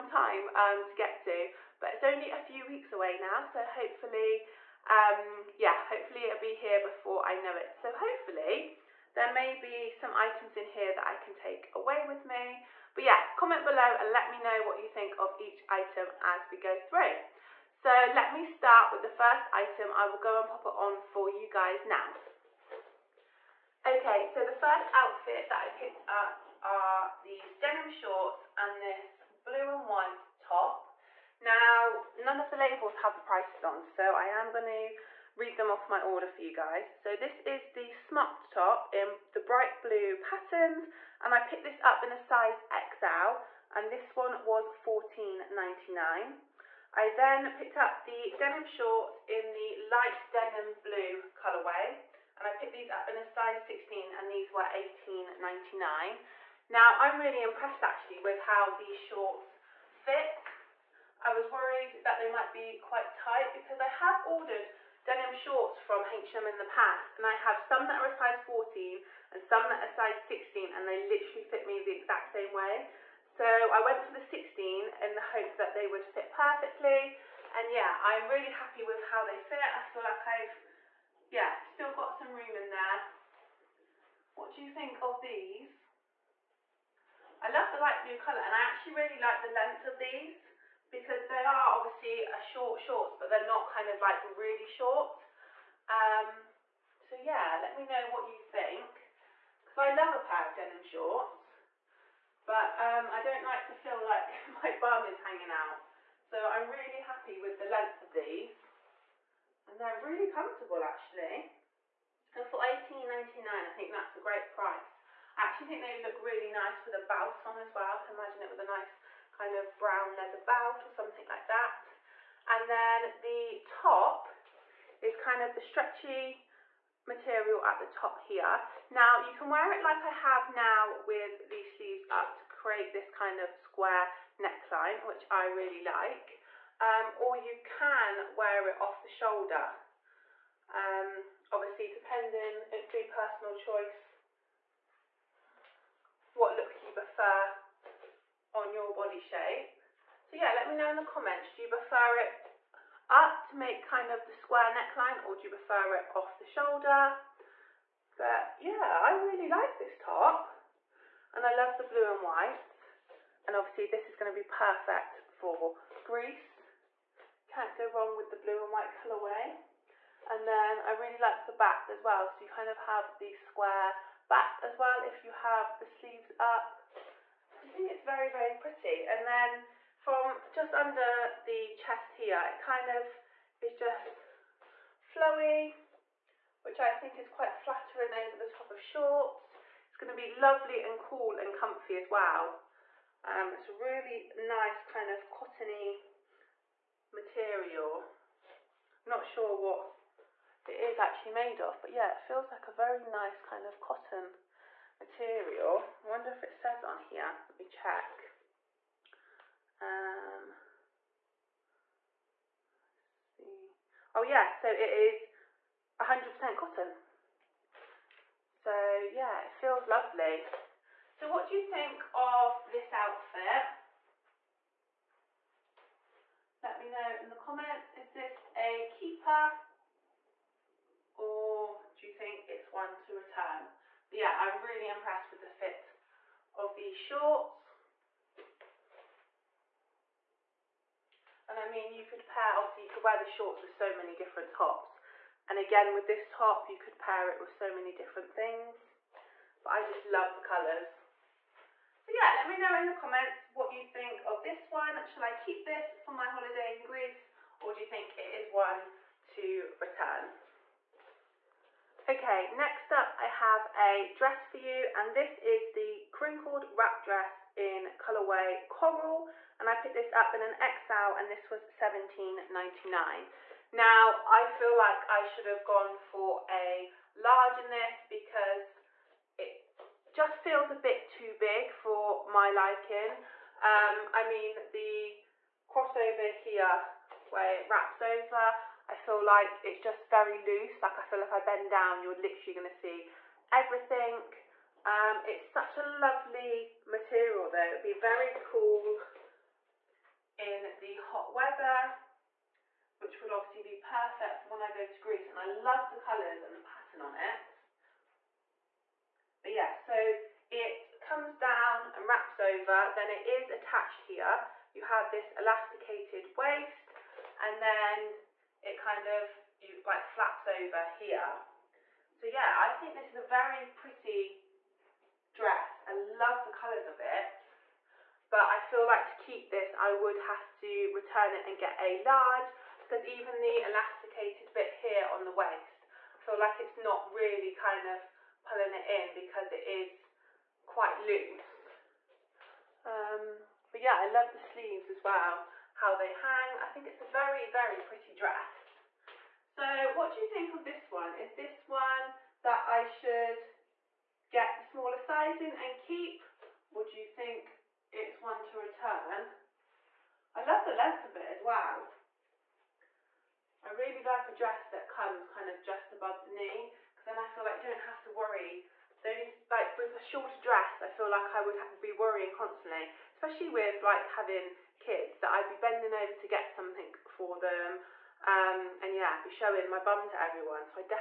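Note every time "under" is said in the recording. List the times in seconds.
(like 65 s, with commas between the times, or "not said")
180 s.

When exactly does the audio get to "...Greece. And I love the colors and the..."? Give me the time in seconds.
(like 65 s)
304 s.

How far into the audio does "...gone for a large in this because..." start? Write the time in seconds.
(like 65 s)
275 s.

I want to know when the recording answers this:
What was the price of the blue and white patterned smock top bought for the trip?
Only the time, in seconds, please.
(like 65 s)
44 s.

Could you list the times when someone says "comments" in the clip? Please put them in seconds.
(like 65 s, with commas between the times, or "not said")
13 s, 151 s, 227 s, 252 s.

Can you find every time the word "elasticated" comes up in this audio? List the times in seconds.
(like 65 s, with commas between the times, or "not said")
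315 s, 333 s.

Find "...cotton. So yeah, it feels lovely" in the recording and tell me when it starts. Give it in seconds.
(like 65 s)
216 s.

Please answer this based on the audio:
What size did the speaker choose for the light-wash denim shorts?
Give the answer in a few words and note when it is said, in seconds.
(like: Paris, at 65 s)
16, at 53 s.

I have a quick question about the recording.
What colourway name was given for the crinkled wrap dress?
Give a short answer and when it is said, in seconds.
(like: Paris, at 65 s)
coral, at 268 s.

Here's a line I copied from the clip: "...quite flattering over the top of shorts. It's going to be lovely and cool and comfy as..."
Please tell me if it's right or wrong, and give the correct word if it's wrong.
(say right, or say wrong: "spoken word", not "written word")
right.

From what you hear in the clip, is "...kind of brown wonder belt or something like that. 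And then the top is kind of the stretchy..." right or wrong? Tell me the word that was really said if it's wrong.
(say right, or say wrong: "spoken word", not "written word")
wrong: "leather", not "wonder".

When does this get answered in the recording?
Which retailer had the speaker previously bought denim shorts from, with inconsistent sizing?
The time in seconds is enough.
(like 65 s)
66 s.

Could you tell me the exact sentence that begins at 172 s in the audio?
So you kind of have the square back as well if you have the sleeves up.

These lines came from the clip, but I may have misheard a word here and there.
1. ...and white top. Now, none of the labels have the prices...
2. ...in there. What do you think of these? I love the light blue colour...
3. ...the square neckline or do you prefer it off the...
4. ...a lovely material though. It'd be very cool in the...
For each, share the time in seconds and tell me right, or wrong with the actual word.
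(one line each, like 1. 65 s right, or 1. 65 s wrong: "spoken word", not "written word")
1. 29 s right
2. 82 s right
3. 154 s right
4. 295 s right.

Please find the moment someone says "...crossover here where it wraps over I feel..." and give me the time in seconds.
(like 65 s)
285 s.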